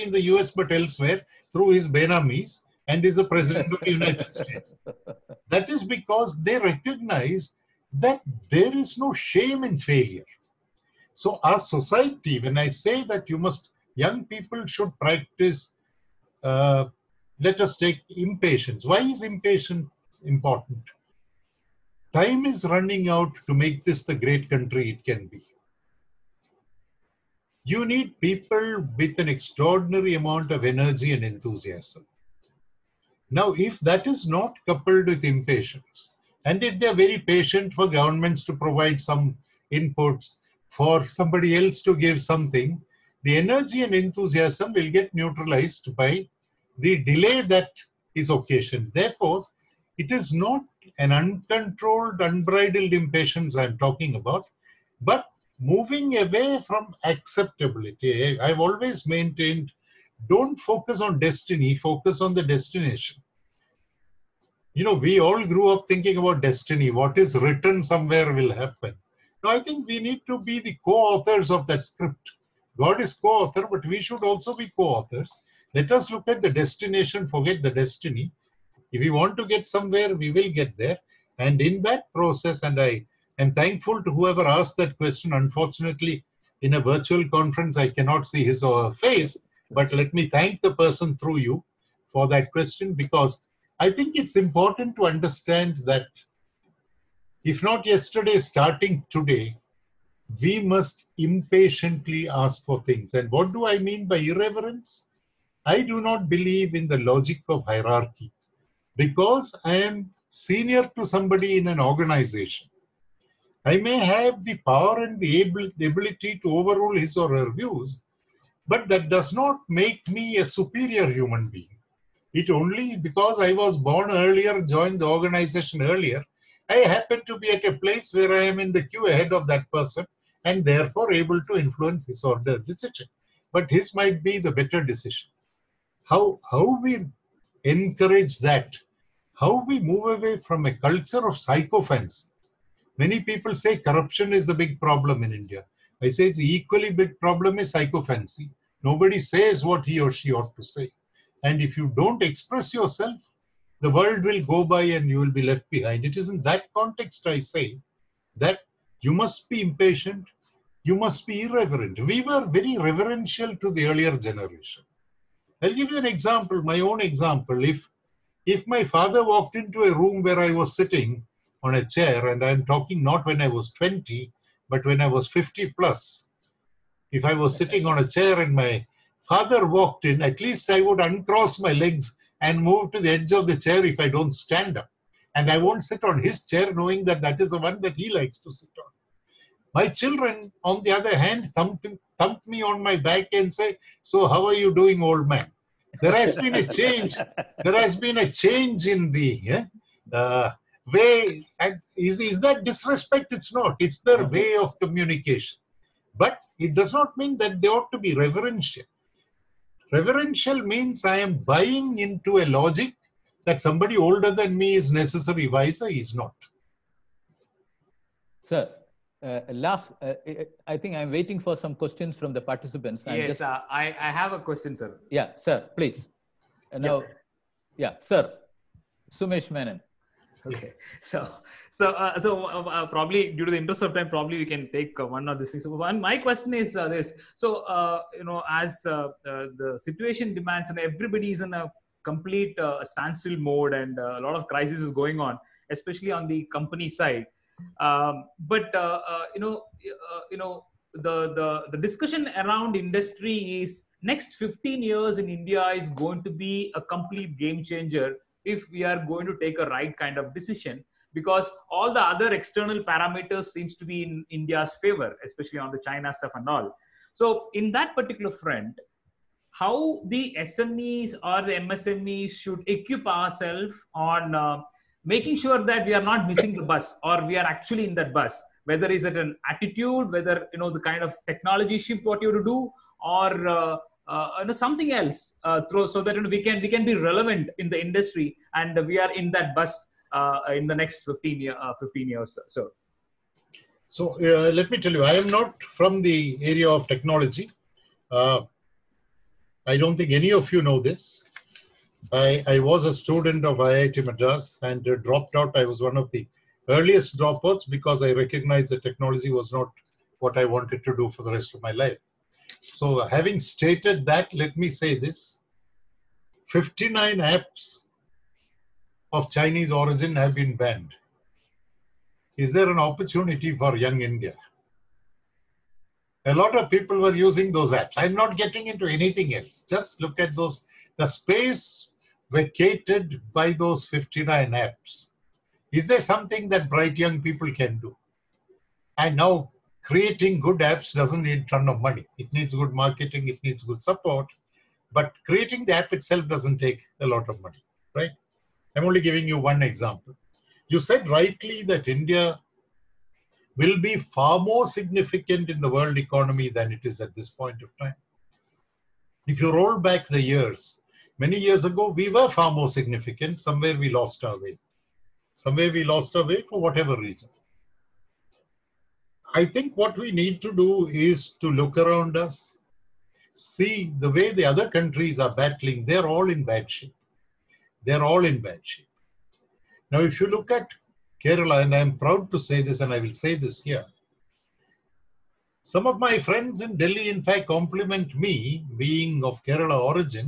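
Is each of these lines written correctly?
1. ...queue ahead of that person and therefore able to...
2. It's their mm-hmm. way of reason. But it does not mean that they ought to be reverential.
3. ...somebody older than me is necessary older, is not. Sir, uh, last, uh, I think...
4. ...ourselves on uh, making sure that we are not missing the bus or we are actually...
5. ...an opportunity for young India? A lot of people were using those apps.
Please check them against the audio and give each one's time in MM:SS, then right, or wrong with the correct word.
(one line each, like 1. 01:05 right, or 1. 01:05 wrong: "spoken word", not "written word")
1. 02:08 right
2. 03:23 wrong: "communication", not "reason"
3. 03:33 wrong: "wiser", not "older"
4. 04:33 right
5. 05:22 right.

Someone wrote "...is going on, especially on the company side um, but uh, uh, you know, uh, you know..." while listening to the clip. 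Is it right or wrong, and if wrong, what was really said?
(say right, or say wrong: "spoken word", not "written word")
right.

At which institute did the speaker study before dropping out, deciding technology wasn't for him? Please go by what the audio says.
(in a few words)
IIT Madras.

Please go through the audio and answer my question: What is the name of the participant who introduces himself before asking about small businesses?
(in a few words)
Sumesh Menon.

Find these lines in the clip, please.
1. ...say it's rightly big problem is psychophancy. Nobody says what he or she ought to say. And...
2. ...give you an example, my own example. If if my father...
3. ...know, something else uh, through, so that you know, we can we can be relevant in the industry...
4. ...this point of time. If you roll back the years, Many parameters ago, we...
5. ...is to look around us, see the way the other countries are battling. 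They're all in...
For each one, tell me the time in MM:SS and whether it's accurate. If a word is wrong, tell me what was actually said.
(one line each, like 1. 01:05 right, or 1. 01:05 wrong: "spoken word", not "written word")
1. 02:26 wrong: "equally", not "rightly"
2. 02:45 right
3. 04:44 right
4. 05:57 wrong: "years", not "parameters"
5. 06:10 right.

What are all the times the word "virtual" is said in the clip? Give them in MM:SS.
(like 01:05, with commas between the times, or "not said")
01:26.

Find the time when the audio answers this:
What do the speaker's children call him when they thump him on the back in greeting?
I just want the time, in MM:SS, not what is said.
03:15.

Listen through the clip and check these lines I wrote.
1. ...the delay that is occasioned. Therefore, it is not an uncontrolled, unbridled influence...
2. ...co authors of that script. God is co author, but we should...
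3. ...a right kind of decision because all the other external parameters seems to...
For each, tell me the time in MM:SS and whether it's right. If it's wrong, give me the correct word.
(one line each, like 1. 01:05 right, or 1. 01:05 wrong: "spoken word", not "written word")
1. 00:46 wrong: "impatience", not "influence"
2. 01:10 right
3. 04:19 right.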